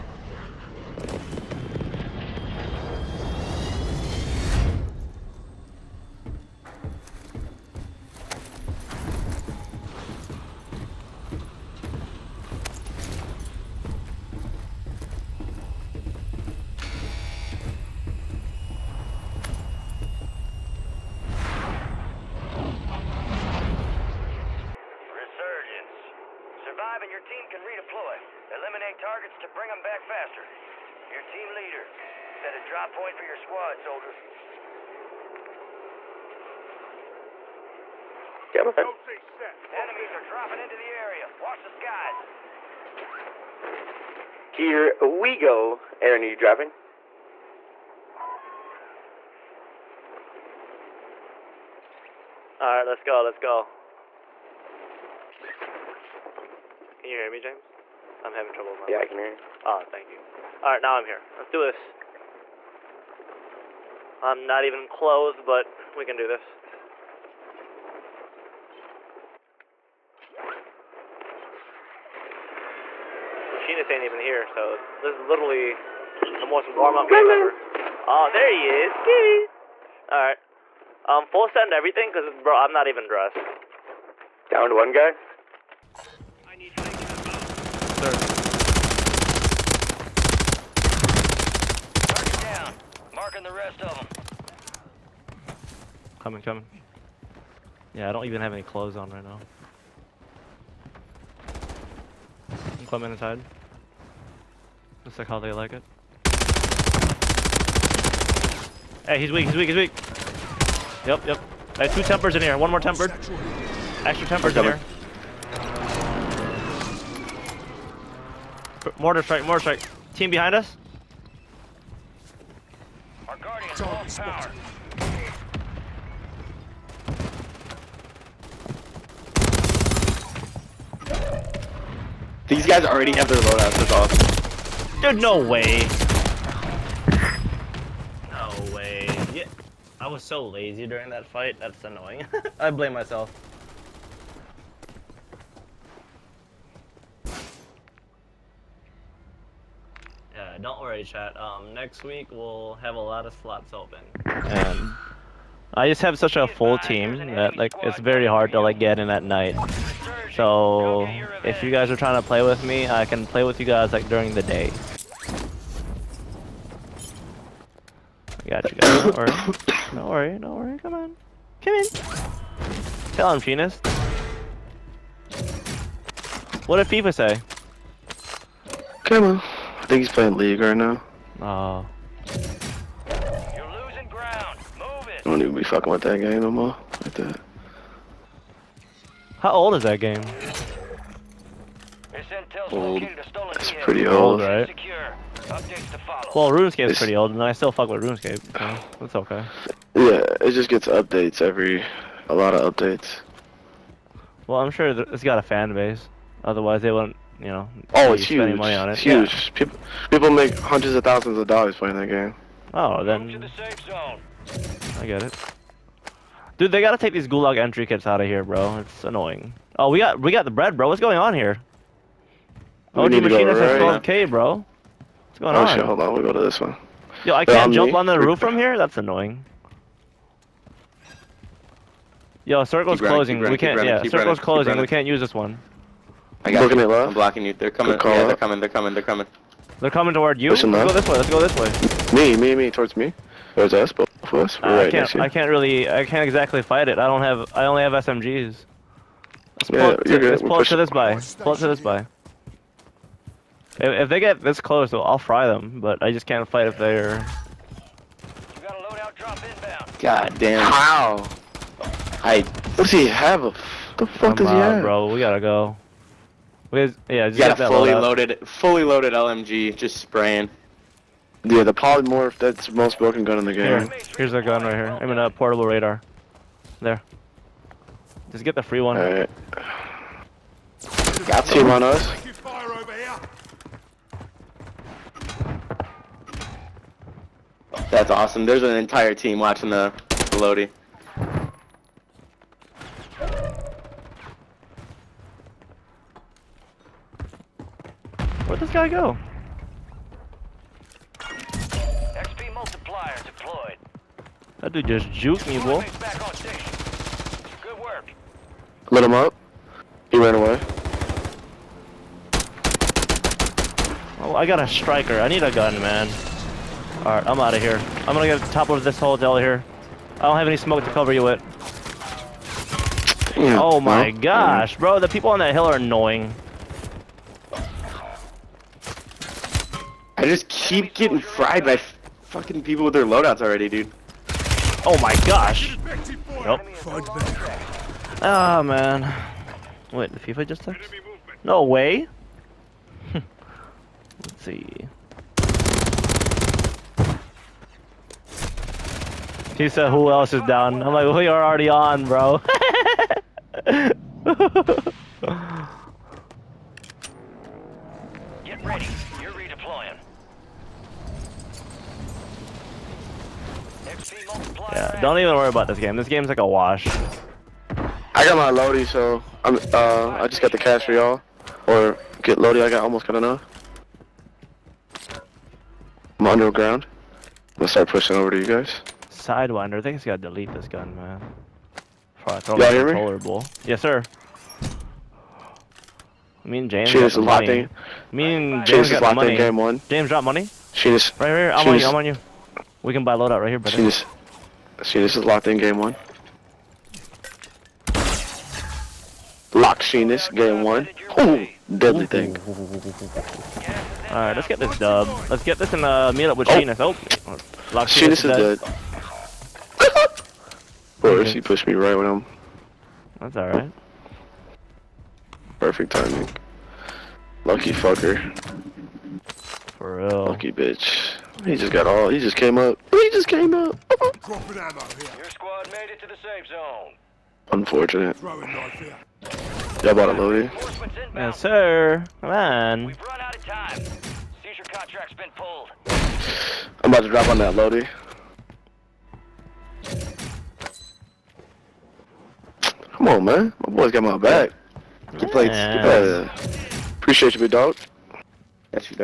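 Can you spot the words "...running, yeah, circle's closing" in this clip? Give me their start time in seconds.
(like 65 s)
233 s.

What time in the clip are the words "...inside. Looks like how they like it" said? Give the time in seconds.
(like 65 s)
103 s.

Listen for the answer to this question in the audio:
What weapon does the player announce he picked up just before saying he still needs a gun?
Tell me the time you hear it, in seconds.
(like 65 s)
314 s.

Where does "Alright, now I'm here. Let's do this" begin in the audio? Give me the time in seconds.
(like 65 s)
60 s.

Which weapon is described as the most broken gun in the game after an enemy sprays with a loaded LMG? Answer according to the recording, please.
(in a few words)
polymorph.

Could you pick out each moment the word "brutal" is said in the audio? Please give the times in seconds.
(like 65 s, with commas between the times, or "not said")
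not said.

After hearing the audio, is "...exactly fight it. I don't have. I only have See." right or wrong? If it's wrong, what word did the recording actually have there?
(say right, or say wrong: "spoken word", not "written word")
wrong: "SMGs", not "See".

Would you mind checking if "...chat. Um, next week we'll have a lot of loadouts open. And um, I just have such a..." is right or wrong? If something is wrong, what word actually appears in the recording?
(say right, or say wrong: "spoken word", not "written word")
wrong: "slots", not "loadouts".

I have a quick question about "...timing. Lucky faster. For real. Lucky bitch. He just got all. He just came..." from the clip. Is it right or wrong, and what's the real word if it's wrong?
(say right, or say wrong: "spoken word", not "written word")
wrong: "fucker", not "faster".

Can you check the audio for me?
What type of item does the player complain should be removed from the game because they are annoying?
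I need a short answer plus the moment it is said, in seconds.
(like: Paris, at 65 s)
gulag entry kits, at 217 s.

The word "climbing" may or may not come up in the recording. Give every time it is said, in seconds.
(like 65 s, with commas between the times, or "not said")
102 s.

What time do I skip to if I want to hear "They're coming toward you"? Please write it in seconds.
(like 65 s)
239 s.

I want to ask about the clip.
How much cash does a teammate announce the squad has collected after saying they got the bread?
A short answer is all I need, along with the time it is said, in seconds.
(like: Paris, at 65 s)
12k, at 224 s.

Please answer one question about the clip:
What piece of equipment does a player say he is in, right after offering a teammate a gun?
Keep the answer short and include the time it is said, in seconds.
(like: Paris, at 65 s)
portable radar, at 275 s.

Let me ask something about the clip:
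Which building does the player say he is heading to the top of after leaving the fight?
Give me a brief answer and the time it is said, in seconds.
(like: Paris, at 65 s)
hotel, at 318 s.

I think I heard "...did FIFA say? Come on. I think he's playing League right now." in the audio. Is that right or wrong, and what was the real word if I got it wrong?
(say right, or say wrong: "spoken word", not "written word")
right.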